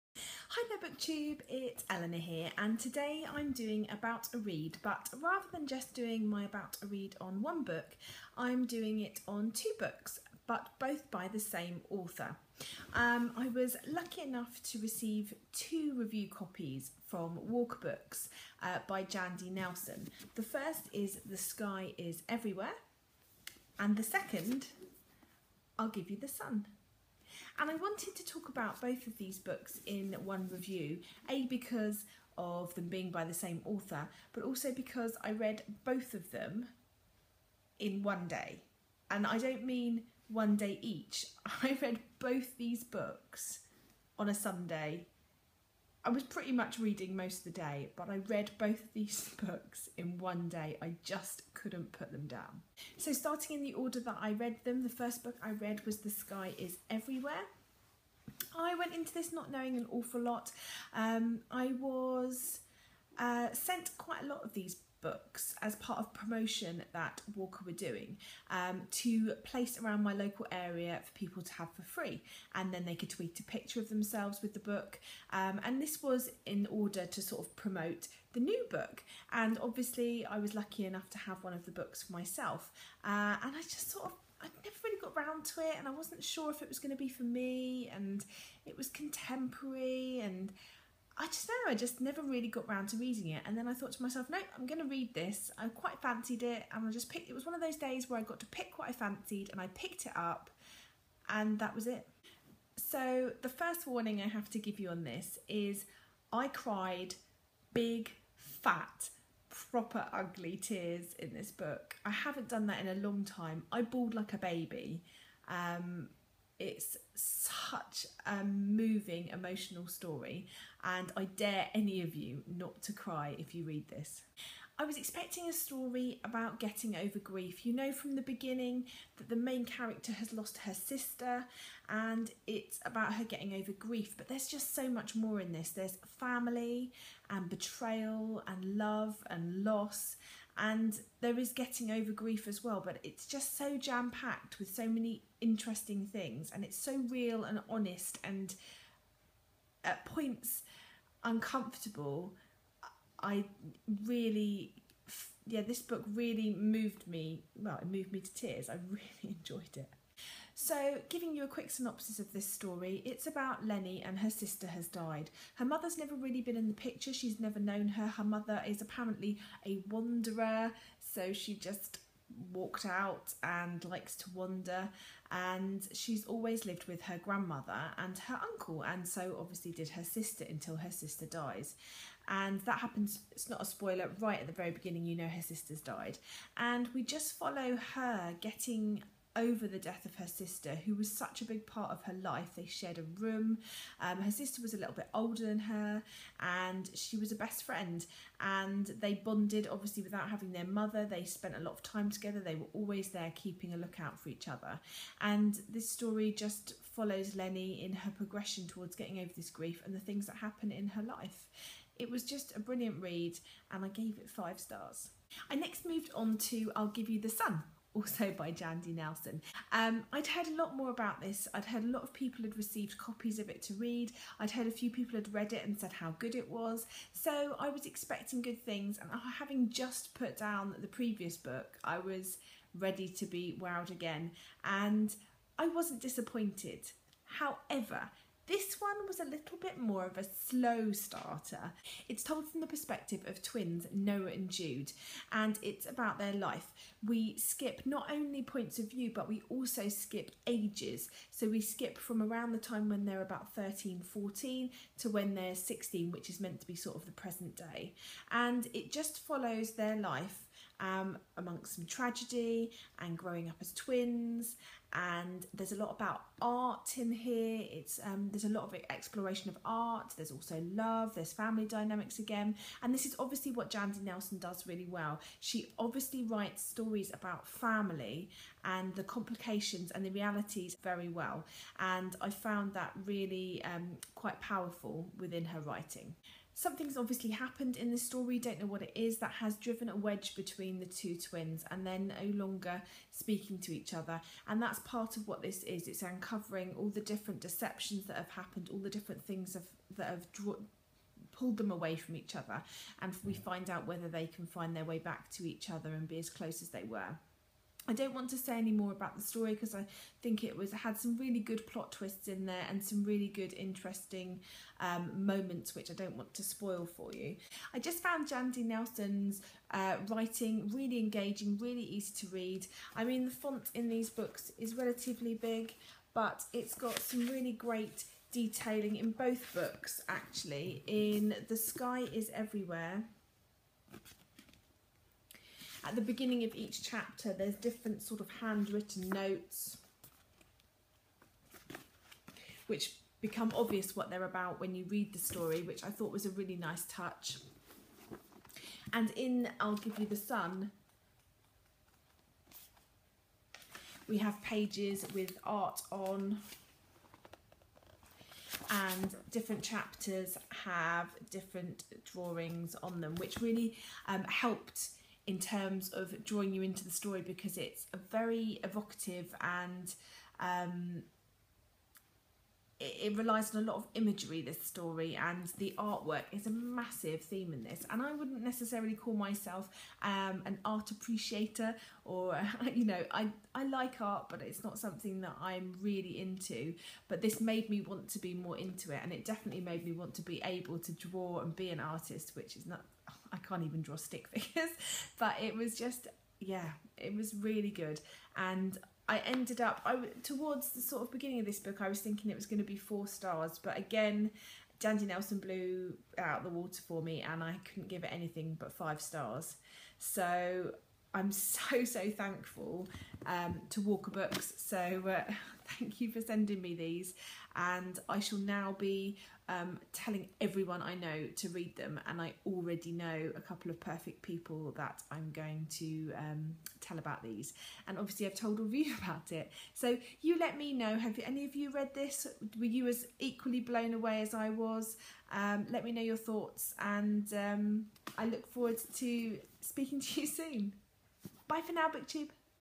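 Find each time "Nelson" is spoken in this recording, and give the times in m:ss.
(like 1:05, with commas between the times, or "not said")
0:19, 3:38, 4:34, 5:18, 6:45.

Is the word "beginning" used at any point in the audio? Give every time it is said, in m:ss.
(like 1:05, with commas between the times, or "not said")
2:08, 3:04, 5:36, 6:41.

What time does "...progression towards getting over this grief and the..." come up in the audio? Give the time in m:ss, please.
3:28.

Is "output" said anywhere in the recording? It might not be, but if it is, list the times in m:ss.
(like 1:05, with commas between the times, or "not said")
not said.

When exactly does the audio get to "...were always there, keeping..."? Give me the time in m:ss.
3:22.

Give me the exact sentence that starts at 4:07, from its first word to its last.
We skip not only points of view, but we also skip ages.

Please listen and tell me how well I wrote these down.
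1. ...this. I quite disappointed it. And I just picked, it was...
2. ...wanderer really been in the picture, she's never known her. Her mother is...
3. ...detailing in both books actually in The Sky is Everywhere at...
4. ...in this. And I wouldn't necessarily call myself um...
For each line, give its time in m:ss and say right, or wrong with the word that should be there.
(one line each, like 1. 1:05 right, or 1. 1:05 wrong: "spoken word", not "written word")
1. 1:35 wrong: "fancied", not "disappointed"
2. 2:45 wrong: "never", not "wanderer"
3. 5:28 right
4. 6:17 right.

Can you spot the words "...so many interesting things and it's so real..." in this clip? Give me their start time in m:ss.
2:24.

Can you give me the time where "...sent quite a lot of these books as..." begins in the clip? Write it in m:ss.
1:03.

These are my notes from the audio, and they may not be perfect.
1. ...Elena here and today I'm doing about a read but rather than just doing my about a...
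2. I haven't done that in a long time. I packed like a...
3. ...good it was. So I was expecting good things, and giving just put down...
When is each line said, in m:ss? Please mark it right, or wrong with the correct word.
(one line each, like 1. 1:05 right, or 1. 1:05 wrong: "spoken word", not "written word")
1. 0:01 right
2. 1:52 wrong: "bawled", not "packed"
3. 3:46 wrong: "having", not "giving".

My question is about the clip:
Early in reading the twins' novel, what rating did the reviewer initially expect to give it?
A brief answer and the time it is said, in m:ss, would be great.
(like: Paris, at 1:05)
4 stars, at 6:42.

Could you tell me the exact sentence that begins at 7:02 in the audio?
And I already know a couple of perfect people that I'm going to um, tell about these.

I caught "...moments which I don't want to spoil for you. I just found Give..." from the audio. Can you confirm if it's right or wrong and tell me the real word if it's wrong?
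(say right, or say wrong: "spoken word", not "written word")
wrong: "Jandy", not "Give".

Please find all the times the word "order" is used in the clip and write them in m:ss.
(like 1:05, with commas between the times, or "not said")
0:53, 1:16.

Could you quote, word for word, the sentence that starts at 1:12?
And then they could tweet a picture of themselves with the book.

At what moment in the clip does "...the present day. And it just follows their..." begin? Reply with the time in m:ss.
4:17.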